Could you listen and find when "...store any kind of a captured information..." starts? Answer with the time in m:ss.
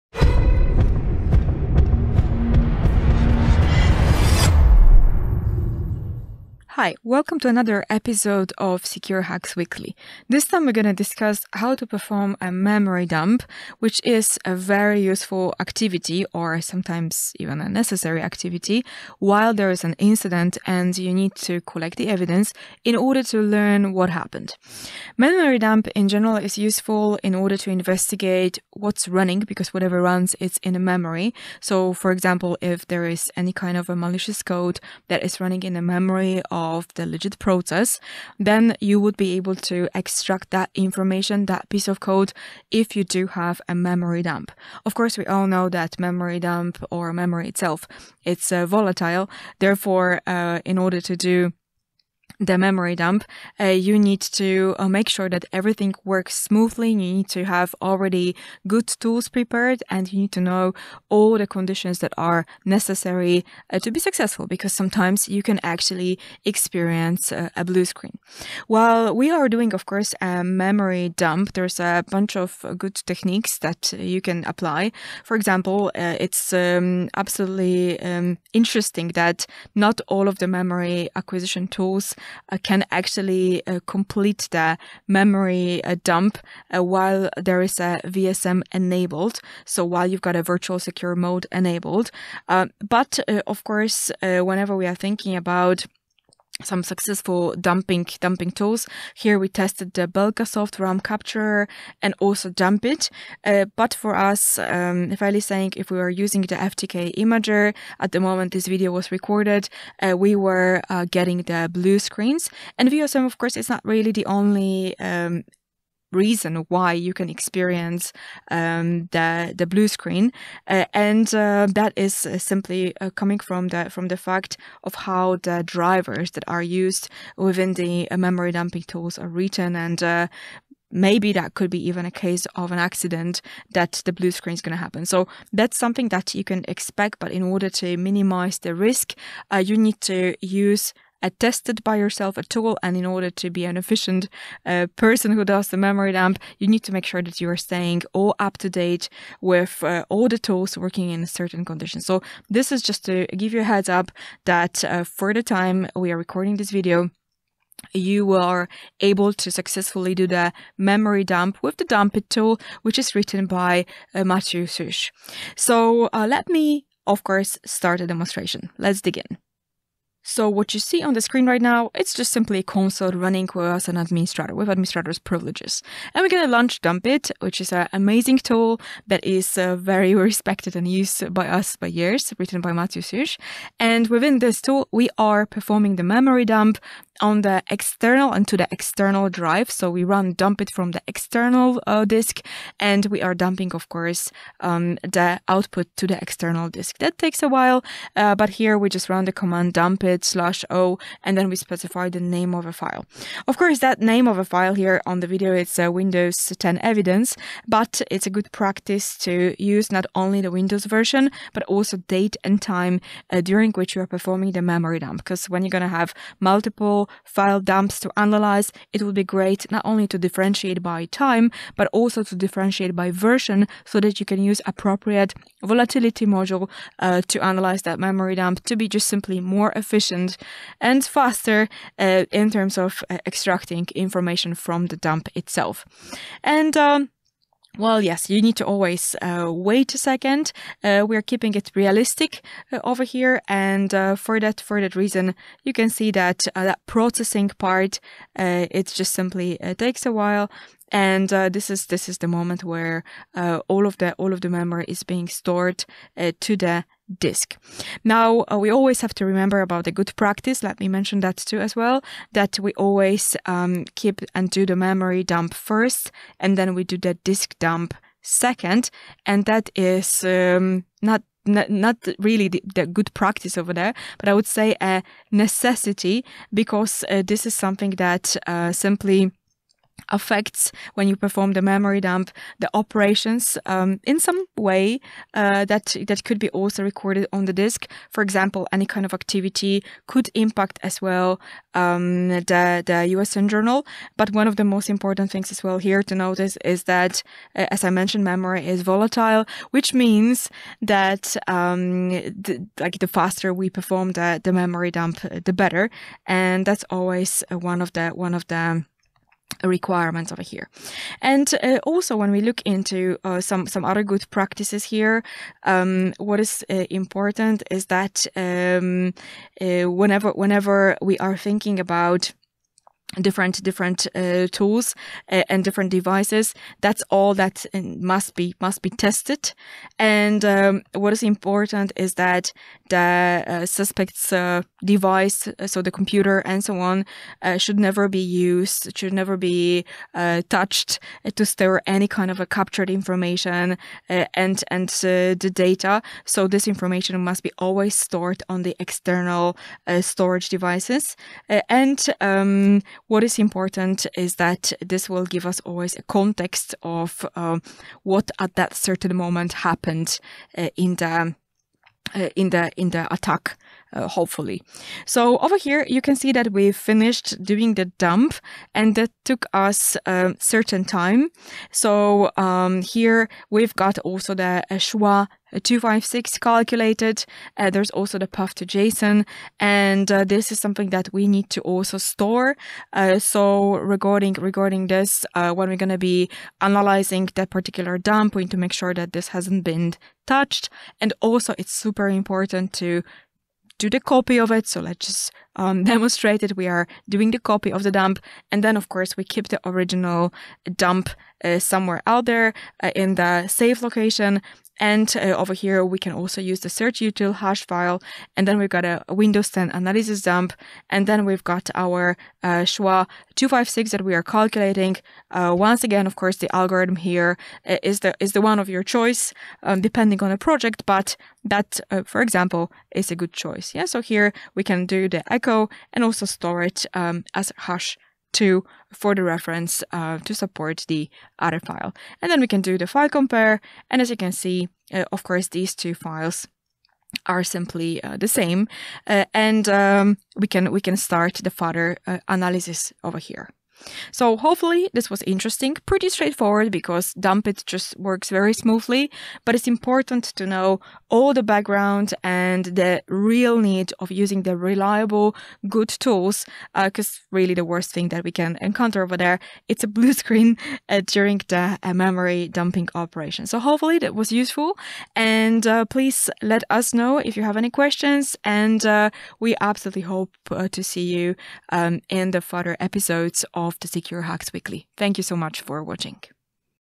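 5:41.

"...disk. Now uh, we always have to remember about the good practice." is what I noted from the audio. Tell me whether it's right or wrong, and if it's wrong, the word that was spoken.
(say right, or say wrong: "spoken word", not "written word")
right.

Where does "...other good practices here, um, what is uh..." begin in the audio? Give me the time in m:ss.
5:13.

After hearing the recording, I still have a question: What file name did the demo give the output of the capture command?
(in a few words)
Windows 10 evidence.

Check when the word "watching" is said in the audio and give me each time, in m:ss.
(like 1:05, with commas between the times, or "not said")
7:55.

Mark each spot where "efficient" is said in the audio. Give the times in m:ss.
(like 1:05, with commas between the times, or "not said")
2:23, 3:49.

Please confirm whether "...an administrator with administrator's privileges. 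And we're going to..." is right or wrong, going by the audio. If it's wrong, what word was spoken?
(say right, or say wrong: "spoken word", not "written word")
right.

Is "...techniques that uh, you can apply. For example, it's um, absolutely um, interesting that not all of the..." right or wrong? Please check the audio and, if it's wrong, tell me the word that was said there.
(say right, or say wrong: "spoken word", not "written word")
right.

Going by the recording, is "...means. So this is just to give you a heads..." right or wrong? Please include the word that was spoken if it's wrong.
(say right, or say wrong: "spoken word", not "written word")
wrong: "conditions", not "means".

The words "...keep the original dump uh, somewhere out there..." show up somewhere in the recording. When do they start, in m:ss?
6:39.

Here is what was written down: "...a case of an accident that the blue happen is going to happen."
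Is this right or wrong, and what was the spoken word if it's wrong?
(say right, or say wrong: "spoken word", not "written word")
wrong: "screen", not "happen".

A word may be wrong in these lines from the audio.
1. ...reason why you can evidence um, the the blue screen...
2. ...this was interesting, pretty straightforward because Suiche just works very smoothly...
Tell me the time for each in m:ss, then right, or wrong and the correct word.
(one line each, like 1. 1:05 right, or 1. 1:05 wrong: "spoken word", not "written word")
1. 1:56 wrong: "experience", not "evidence"
2. 7:24 wrong: "DumpIt", not "Suiche".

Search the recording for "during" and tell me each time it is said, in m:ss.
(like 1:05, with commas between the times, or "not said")
3:33, 7:41.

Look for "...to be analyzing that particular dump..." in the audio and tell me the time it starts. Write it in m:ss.
6:25.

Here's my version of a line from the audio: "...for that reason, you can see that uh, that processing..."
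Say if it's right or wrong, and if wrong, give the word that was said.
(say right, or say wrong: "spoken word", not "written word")
right.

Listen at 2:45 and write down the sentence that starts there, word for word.
So uh, let me, of course, start a demonstration.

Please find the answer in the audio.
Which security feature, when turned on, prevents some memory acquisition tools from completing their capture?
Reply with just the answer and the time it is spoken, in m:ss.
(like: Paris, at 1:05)
Virtual secure mode, at 1:30.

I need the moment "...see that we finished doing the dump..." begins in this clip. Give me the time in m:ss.
6:06.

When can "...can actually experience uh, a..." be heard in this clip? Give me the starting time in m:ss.
1:05.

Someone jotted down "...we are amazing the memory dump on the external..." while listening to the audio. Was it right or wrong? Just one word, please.
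wrong.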